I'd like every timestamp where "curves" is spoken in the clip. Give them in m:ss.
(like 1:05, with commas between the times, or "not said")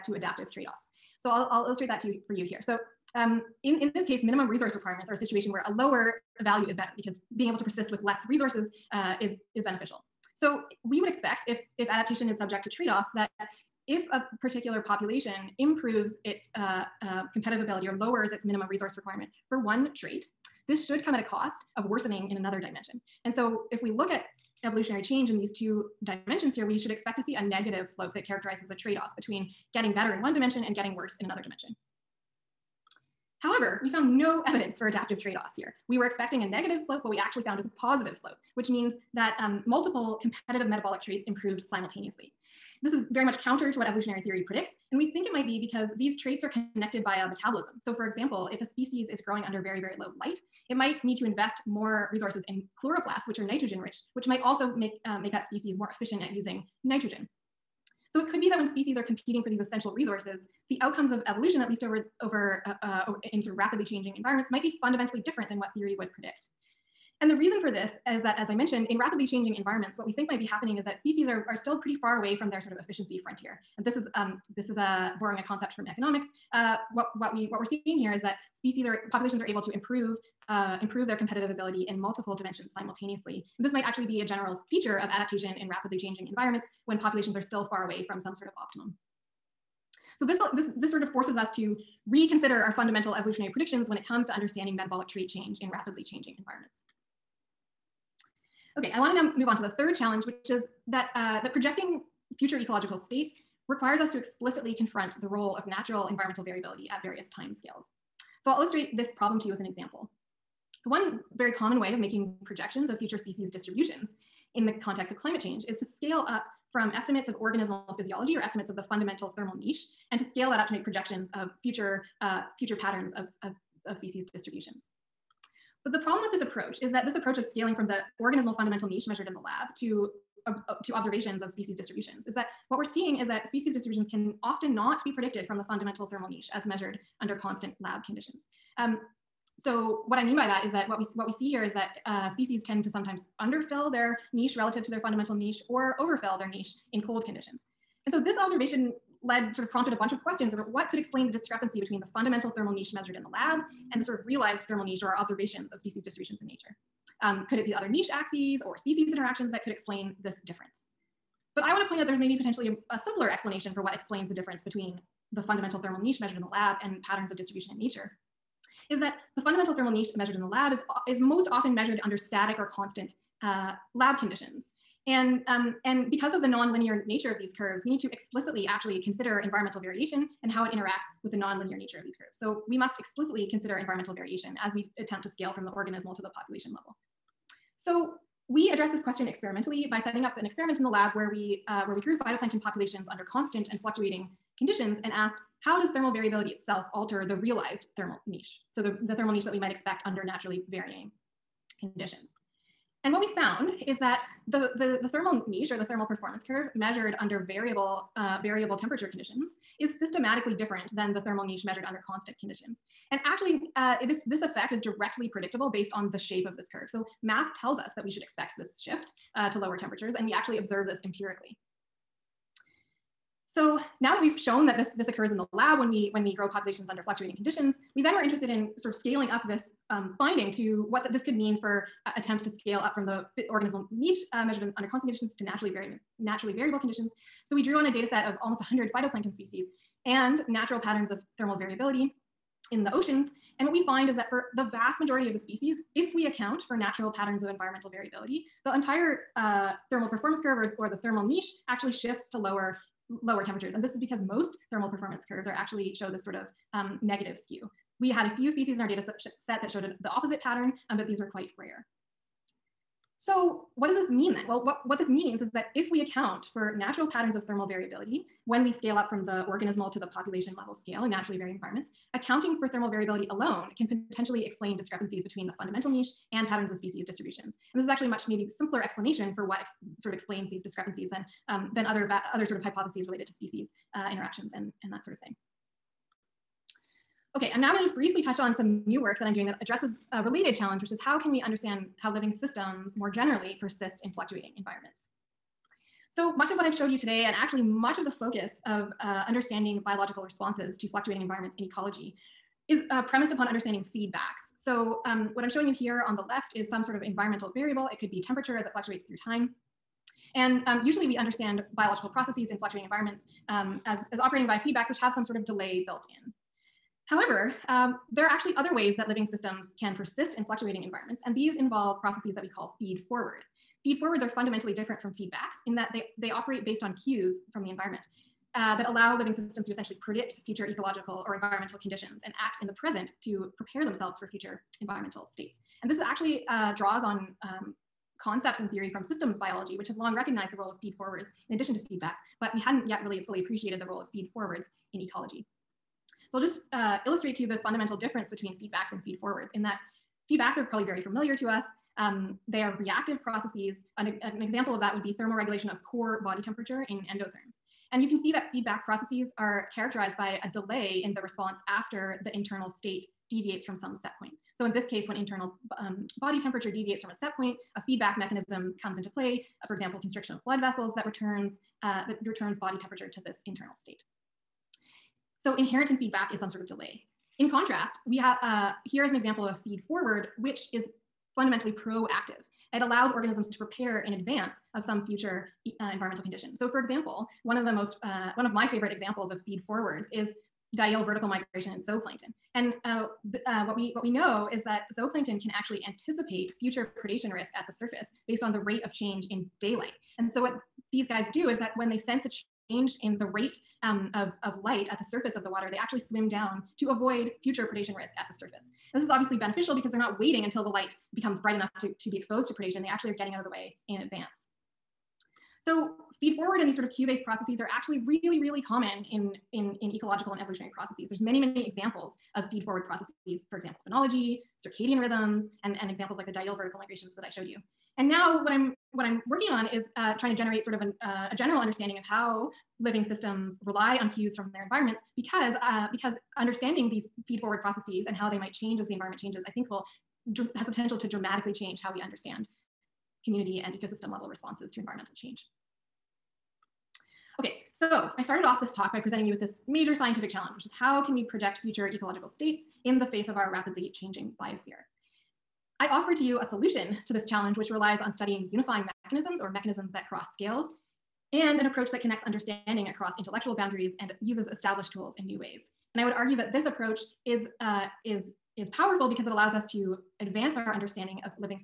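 2:57, 3:02, 3:26, 3:36, 4:10, 4:15.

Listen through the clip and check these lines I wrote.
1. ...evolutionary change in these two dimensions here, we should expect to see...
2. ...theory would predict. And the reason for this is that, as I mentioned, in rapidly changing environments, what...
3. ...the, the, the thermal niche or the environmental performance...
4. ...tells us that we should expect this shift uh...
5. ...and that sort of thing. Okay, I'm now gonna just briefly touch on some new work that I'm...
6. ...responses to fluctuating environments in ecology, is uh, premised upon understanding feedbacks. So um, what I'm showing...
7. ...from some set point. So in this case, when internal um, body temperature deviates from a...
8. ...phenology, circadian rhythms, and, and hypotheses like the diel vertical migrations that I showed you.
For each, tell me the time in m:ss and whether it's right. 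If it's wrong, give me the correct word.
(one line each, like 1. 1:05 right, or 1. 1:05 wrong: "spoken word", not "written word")
1. 0:24 right
2. 1:05 right
3. 3:24 wrong: "thermal", not "environmental"
4. 3:37 right
5. 4:44 right
6. 5:00 right
7. 6:03 right
8. 7:03 wrong: "examples", not "hypotheses".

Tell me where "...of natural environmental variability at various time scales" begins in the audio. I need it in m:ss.
1:45.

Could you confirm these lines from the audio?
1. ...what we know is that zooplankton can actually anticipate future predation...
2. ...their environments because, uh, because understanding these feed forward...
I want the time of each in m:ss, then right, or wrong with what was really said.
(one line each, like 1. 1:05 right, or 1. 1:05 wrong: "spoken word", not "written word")
1. 6:33 right
2. 7:14 right.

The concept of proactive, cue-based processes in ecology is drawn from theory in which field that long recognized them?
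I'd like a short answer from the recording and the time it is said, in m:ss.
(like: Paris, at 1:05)
Systems biology, at 5:39.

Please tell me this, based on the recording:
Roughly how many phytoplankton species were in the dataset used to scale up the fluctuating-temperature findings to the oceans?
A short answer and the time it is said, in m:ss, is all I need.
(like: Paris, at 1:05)
Almost 100, at 3:58.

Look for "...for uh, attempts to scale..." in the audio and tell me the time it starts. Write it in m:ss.
3:51.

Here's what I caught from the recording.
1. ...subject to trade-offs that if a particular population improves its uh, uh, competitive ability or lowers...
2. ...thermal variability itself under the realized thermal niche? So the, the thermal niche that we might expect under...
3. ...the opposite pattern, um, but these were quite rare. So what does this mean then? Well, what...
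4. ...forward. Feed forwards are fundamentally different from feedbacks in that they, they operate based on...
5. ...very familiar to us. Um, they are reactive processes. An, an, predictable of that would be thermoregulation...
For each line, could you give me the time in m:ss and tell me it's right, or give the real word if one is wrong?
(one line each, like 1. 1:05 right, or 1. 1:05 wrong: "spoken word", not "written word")
1. 0:12 right
2. 3:15 wrong: "alter", not "under"
3. 4:20 right
4. 5:23 right
5. 5:50 wrong: "example", not "predictable".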